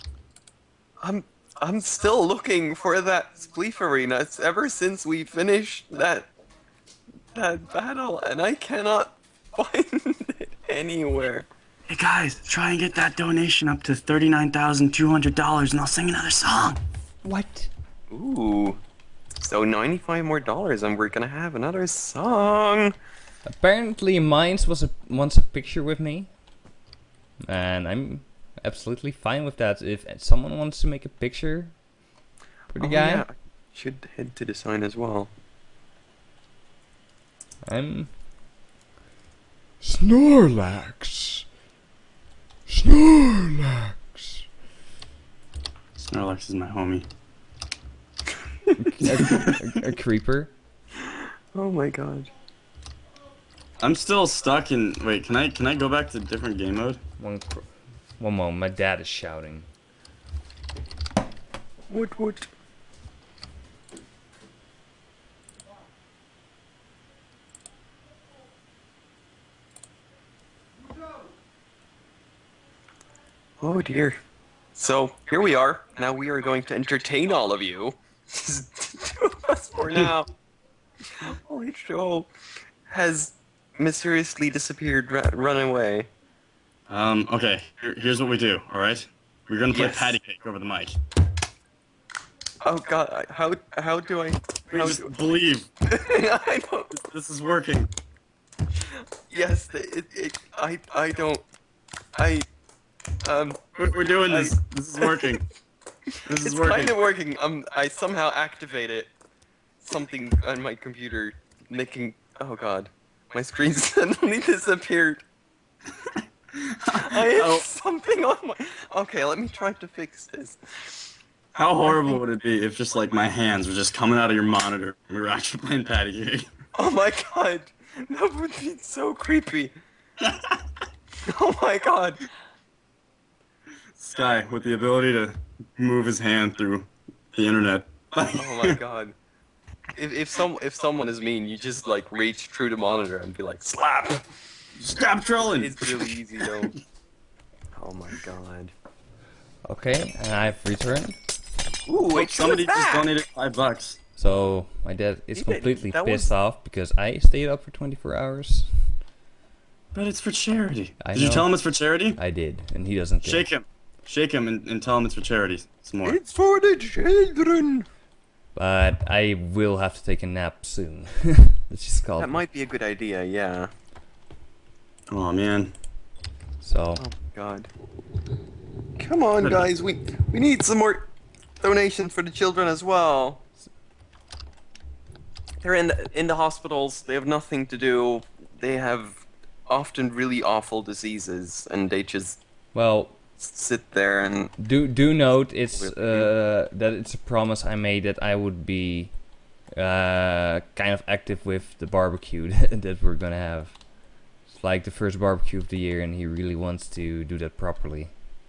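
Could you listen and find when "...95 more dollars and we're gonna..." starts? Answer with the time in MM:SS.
00:19.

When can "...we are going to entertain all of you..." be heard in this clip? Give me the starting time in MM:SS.
01:16.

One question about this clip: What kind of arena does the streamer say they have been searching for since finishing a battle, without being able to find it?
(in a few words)
spleef arena.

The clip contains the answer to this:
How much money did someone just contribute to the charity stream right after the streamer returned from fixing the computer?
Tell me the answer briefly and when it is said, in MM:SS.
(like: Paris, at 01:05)
$5, at 02:33.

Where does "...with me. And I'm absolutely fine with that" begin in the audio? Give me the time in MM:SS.
00:25.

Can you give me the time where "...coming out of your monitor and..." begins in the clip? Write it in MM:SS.
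02:03.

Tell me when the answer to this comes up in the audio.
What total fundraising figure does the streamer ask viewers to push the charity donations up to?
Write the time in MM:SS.
00:13.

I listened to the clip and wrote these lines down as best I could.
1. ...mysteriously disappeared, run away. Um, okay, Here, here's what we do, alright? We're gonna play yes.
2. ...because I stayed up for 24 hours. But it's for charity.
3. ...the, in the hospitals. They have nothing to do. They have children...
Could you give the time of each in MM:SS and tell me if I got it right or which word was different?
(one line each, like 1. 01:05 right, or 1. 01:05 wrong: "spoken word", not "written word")
1. 01:23 right
2. 02:36 right
3. 03:05 wrong: "often", not "children".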